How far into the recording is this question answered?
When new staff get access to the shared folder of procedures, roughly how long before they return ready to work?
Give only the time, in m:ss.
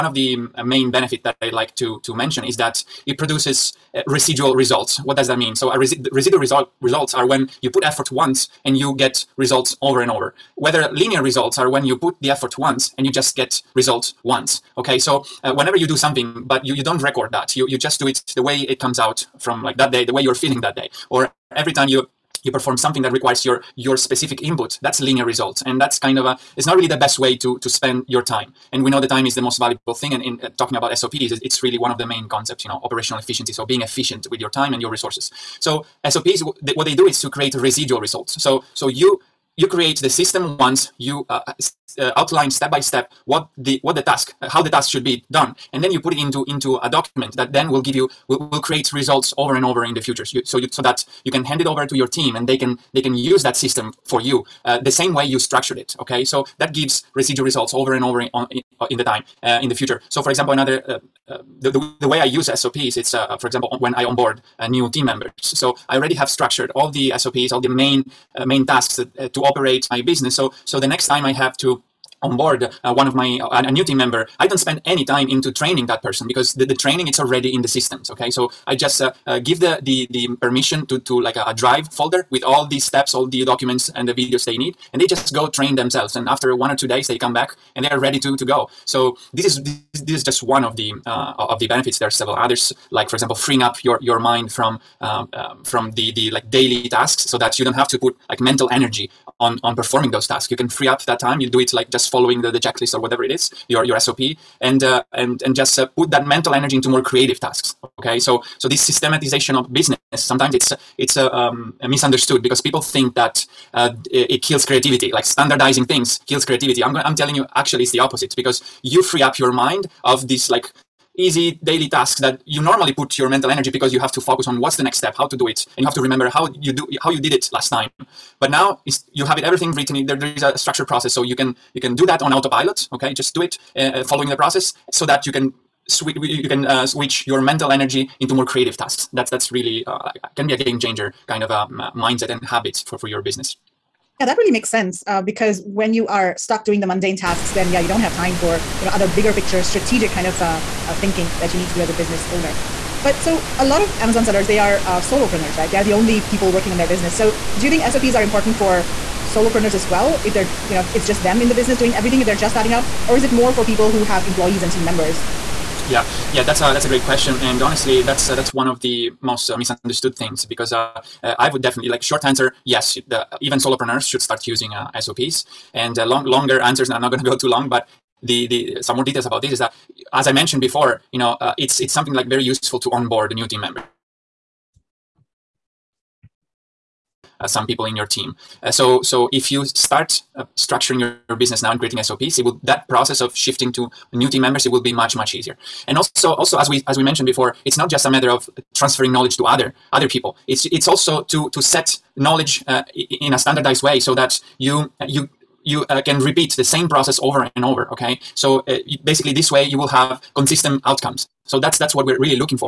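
1:26.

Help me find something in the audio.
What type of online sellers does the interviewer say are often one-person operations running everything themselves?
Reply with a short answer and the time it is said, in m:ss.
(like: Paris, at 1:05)
Amazon sellers, at 2:33.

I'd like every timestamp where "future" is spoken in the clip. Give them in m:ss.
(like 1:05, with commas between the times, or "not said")
0:50, 0:59.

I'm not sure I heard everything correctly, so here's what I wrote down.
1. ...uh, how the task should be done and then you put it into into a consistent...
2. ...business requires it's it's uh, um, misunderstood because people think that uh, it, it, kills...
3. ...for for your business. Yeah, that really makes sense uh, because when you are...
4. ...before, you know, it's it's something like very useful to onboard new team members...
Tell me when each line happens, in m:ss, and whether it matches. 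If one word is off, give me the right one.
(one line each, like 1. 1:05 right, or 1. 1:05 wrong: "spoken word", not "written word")
1. 0:44 wrong: "document", not "consistent"
2. 1:49 wrong: "sometimes", not "requires"
3. 2:22 right
4. 3:00 right.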